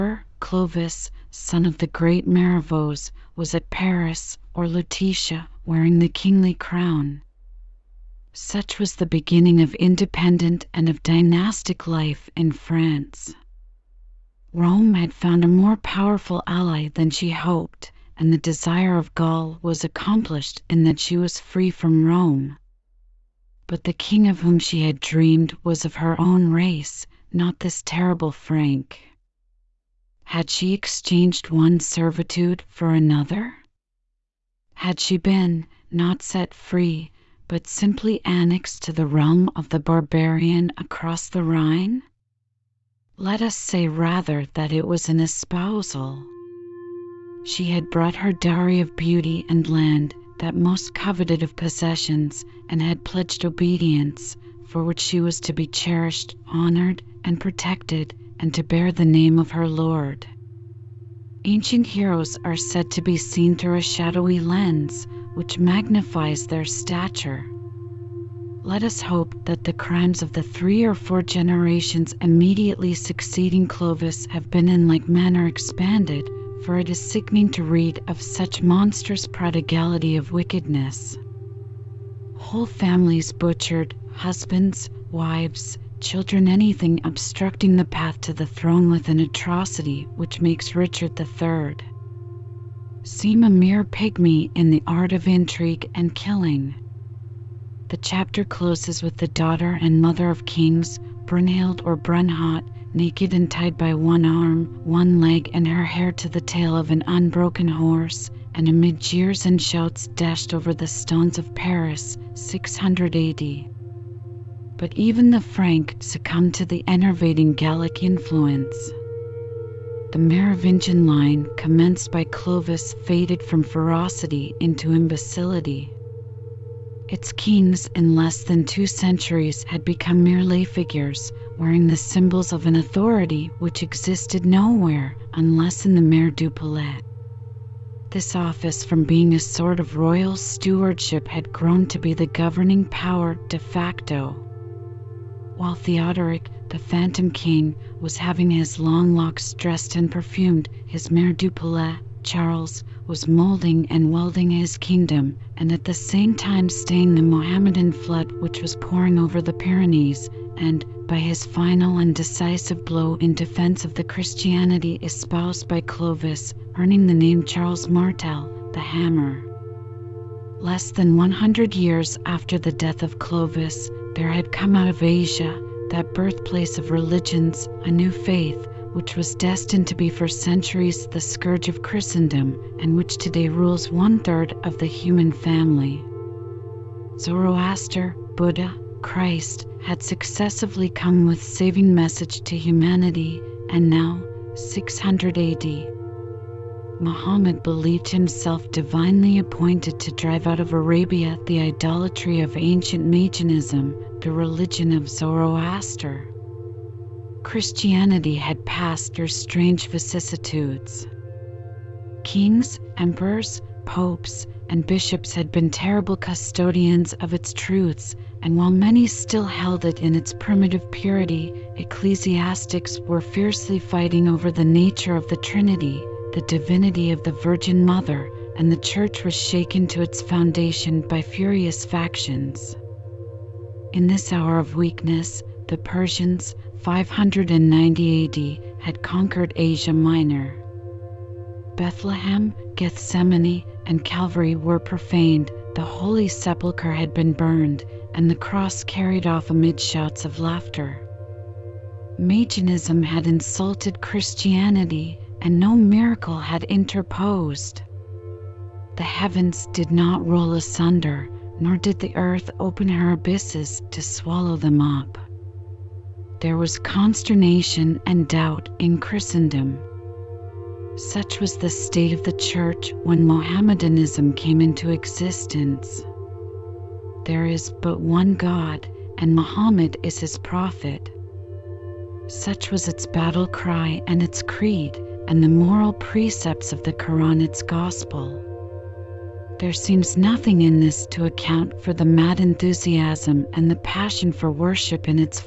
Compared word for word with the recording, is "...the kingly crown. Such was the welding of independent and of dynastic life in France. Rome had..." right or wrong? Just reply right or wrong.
wrong.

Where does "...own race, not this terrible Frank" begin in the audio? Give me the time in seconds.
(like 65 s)
26 s.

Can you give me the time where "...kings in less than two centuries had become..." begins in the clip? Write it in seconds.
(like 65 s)
127 s.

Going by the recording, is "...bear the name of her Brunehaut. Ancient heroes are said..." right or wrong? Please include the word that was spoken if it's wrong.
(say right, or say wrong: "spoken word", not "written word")
wrong: "Lord", not "Brunehaut".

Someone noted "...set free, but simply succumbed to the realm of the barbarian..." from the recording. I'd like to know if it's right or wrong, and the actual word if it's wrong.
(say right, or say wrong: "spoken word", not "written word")
wrong: "annexed", not "succumbed".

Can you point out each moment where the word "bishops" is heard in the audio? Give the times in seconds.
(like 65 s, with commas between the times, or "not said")
214 s.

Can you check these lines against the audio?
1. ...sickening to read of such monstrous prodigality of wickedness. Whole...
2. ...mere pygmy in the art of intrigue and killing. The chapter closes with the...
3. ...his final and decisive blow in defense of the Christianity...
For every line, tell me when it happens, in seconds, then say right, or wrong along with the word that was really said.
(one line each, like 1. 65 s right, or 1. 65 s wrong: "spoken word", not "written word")
1. 76 s right
2. 93 s right
3. 161 s right.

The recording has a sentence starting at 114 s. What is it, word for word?
But even the Frank succumbed to the enervating Gallic influence.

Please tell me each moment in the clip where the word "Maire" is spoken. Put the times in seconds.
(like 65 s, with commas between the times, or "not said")
136 s, 151 s.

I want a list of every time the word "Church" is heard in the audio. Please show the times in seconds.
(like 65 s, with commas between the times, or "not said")
228 s, 272 s.